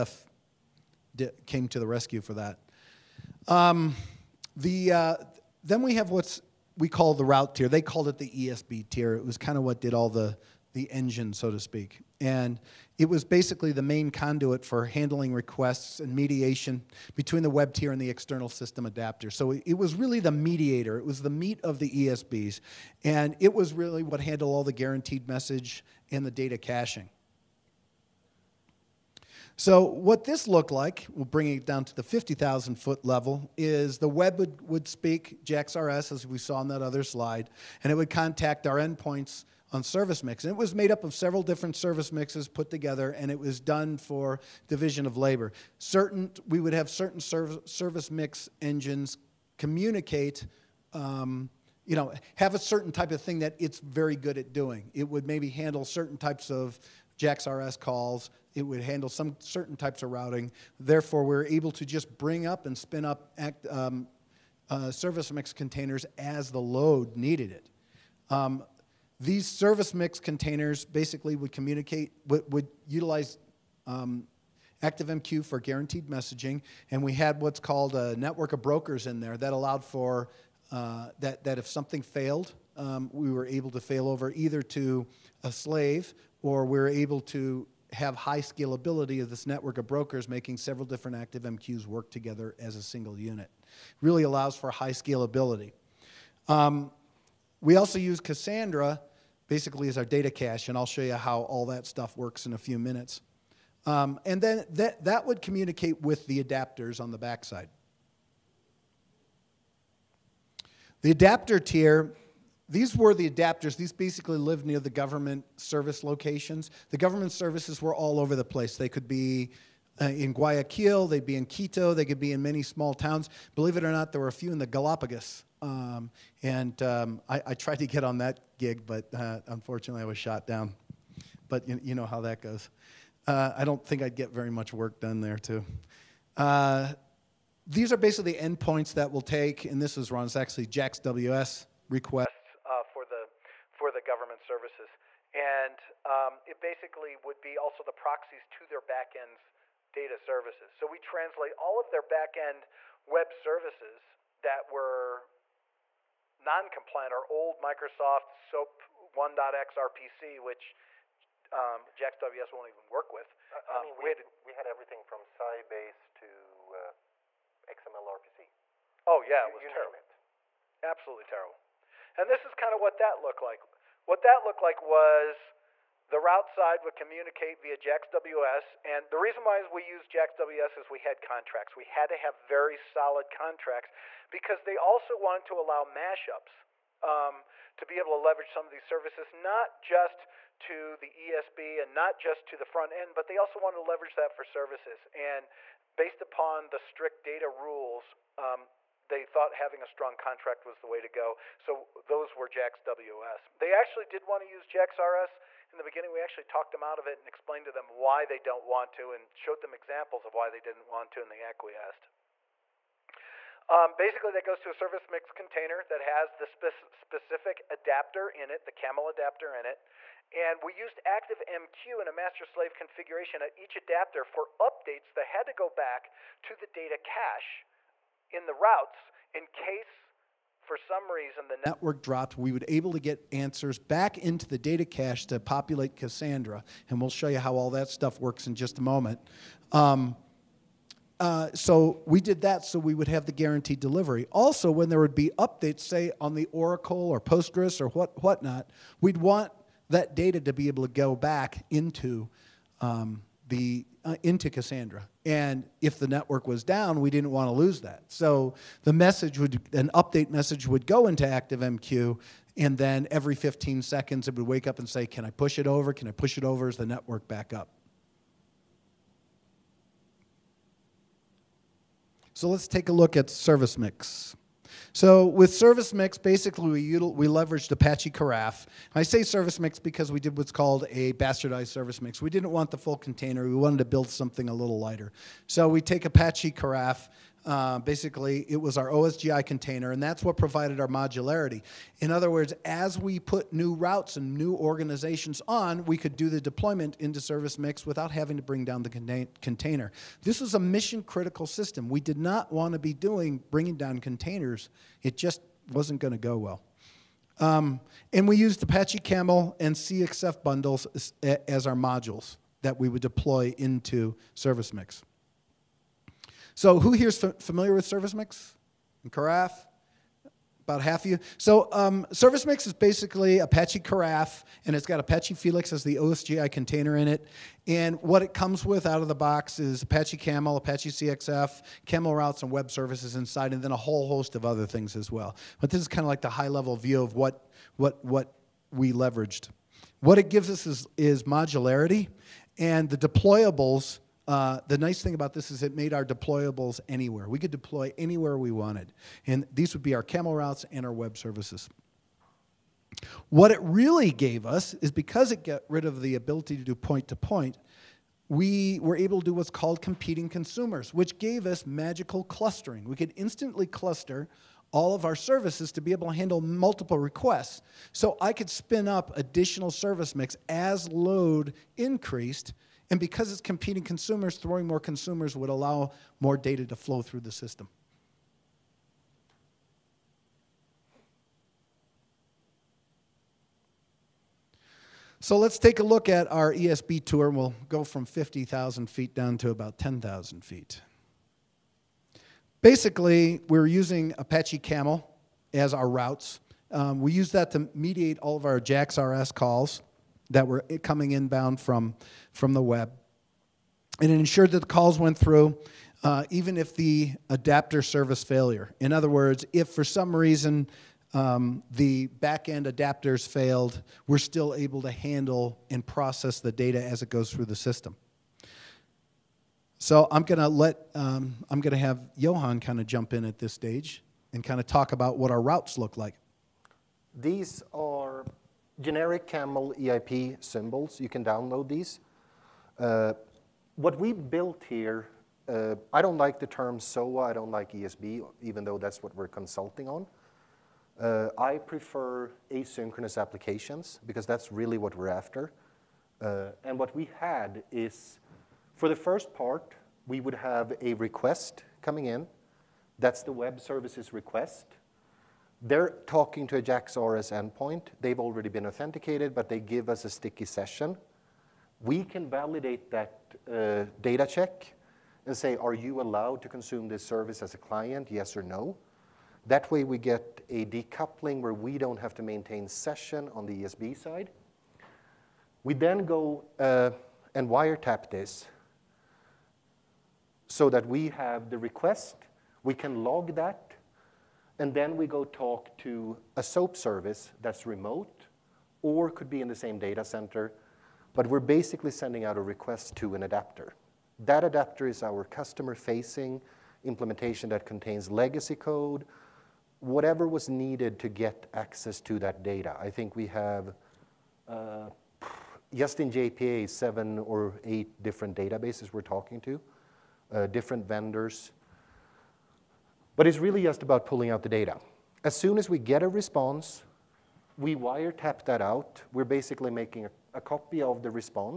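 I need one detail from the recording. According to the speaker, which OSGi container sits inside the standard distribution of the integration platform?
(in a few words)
Apache Felix.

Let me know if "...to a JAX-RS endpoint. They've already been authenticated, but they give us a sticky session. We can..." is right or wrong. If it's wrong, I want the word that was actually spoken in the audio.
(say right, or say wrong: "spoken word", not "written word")
right.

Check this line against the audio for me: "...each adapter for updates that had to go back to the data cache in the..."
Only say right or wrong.
right.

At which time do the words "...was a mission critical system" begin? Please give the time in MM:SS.
05:00.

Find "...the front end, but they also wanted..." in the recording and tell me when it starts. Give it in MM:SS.
03:12.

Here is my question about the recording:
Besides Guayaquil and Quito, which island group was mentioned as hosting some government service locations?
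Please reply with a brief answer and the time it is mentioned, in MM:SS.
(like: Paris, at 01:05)
Galapagos, at 02:04.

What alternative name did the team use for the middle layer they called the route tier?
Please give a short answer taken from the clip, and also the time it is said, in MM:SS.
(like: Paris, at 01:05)
ESB tier, at 00:08.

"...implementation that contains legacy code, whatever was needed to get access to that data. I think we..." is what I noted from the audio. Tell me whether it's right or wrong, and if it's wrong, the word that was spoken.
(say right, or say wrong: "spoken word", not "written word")
right.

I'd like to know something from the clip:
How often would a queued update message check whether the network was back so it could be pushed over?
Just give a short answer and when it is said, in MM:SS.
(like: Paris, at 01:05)
every 15 seconds, at 04:23.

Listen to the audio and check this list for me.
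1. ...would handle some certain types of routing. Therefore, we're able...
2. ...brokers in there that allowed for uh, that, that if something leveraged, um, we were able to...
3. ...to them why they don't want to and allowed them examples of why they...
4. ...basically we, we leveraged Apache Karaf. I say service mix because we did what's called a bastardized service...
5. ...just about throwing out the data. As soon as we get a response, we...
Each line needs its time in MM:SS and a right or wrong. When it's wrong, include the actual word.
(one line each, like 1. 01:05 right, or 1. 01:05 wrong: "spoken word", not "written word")
1. 00:58 right
2. 01:18 wrong: "failed", not "leveraged"
3. 03:27 wrong: "showed", not "allowed"
4. 04:36 right
5. 08:33 wrong: "pulling", not "throwing".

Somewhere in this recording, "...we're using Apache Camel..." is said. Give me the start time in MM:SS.
06:33.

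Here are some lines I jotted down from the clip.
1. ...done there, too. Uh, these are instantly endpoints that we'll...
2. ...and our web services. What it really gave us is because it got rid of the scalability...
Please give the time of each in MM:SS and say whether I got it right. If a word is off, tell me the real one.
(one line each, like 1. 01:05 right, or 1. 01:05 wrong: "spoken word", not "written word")
1. 02:14 wrong: "basically", not "instantly"
2. 05:50 wrong: "ability", not "scalability".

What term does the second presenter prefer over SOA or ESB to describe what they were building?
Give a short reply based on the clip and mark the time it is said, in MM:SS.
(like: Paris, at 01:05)
asynchronous applications, at 07:22.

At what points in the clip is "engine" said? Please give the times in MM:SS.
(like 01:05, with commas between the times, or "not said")
00:10, 00:48.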